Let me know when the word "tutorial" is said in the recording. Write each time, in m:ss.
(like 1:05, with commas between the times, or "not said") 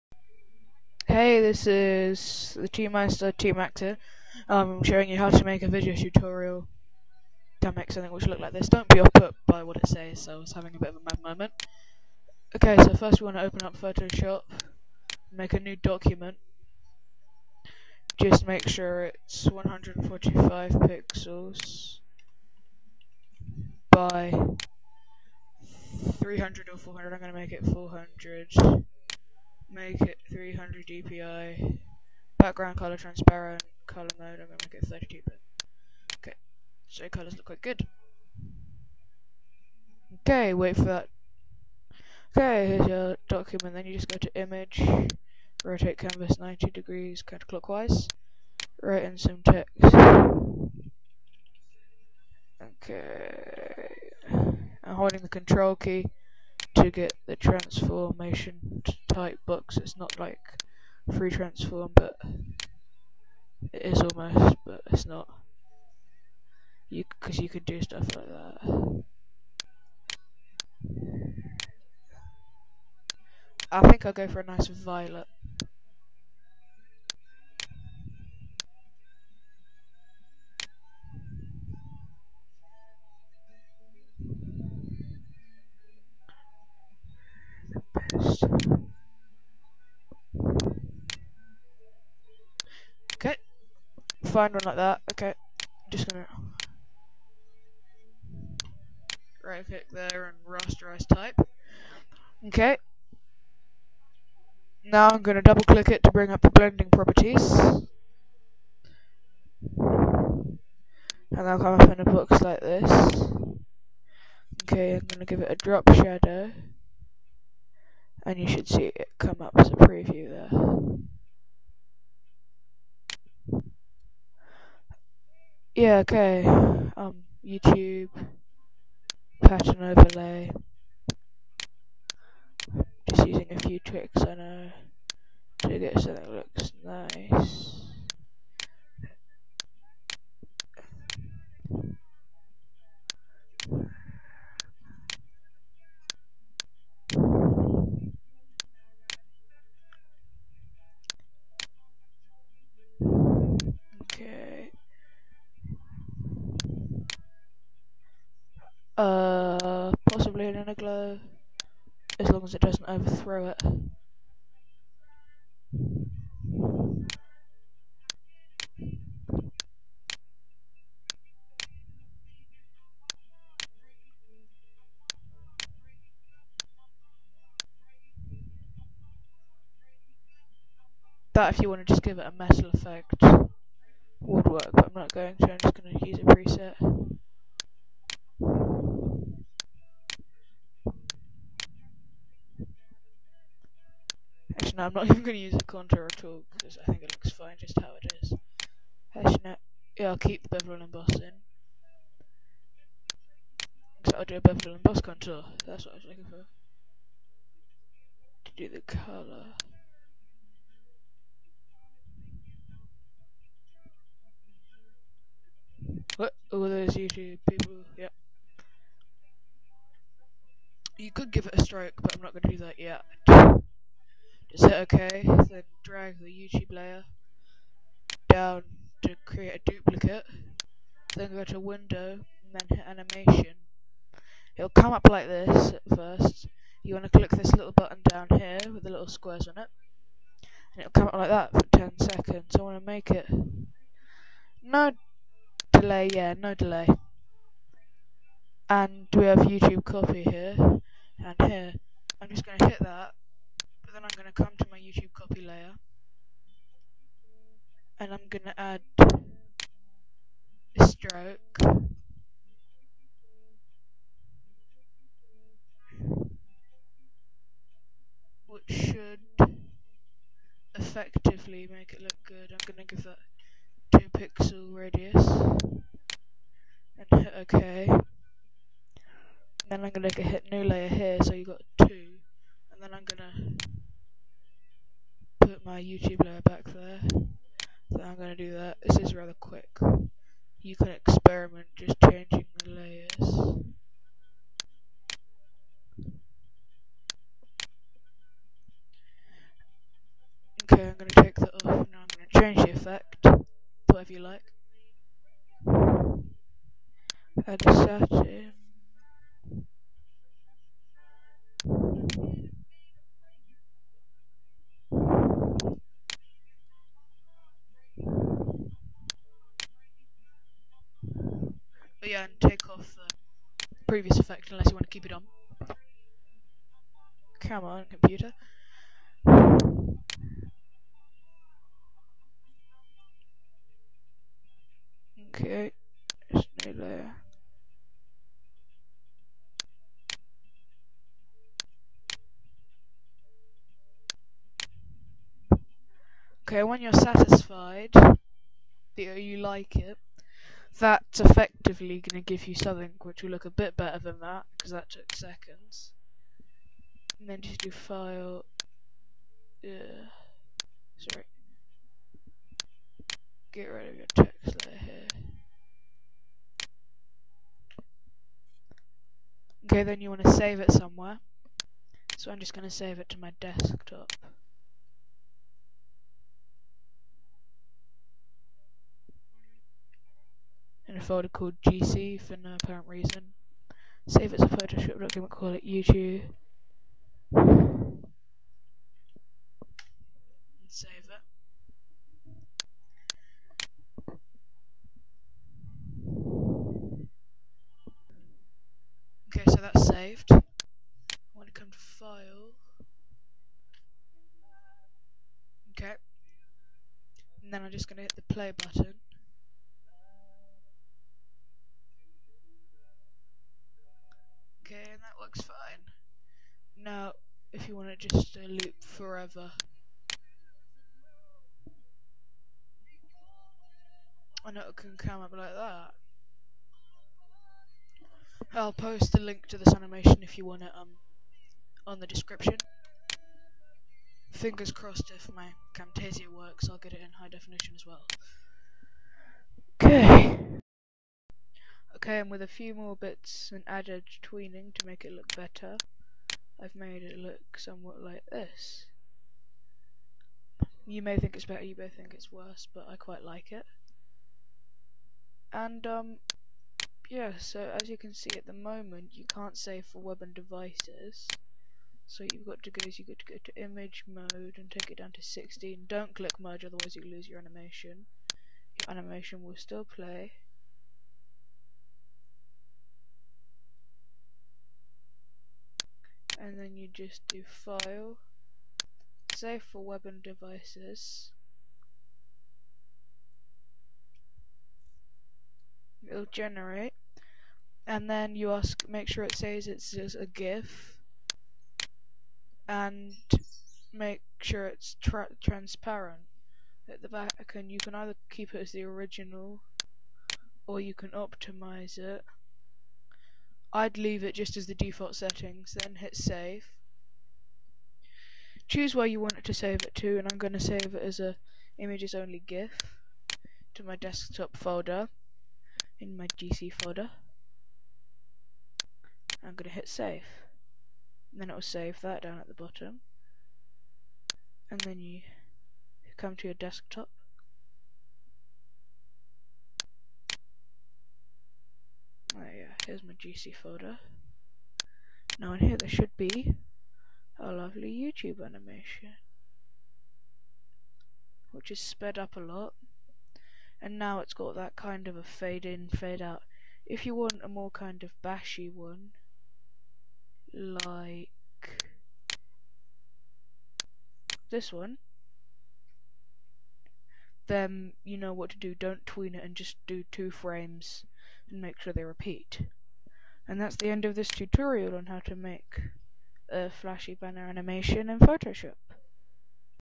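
0:05, 9:24.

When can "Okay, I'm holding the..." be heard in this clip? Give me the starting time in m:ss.
0:52.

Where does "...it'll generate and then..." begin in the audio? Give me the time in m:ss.
8:06.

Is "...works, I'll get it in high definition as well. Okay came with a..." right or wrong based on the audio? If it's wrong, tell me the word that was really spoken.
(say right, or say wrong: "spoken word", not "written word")
right.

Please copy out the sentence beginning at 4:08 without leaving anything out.
And we have YouTube copy here and here.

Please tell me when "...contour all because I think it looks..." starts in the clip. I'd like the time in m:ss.
3:15.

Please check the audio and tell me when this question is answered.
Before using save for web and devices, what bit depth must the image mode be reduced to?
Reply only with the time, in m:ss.
7:45.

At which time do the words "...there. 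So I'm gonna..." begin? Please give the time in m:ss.
4:46.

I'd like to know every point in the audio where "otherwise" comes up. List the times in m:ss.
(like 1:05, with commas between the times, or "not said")
7:46.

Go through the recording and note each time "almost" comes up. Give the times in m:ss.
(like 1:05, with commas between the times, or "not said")
1:04.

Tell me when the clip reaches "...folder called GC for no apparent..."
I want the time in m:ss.
6:21.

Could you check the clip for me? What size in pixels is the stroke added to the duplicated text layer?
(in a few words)
2 pixels.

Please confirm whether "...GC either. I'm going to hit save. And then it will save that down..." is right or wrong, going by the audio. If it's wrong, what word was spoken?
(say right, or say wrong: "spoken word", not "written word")
wrong: "folder", not "either".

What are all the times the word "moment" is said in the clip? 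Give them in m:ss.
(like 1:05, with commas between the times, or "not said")
0:11, 7:38.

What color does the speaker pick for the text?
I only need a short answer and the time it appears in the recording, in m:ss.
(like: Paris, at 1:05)
Violet, at 1:14.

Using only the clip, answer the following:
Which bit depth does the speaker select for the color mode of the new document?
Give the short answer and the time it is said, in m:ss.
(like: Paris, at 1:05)
32 bit, at 0:34.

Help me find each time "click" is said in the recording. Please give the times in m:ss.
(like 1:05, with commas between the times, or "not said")
1:39, 1:45, 3:57, 7:46.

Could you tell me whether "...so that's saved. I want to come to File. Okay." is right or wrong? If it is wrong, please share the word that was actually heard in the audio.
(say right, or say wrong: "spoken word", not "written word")
right.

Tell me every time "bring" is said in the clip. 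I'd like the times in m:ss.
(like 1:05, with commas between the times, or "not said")
1:46.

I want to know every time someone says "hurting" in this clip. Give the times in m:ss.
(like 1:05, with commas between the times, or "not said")
not said.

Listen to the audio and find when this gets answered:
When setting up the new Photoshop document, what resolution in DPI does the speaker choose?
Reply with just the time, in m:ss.
0:30.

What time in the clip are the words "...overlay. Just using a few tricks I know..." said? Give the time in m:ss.
2:09.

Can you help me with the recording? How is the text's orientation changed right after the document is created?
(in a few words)
Rotate canvas 90 degrees counterclockwise.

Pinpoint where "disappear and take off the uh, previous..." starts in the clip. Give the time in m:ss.
5:22.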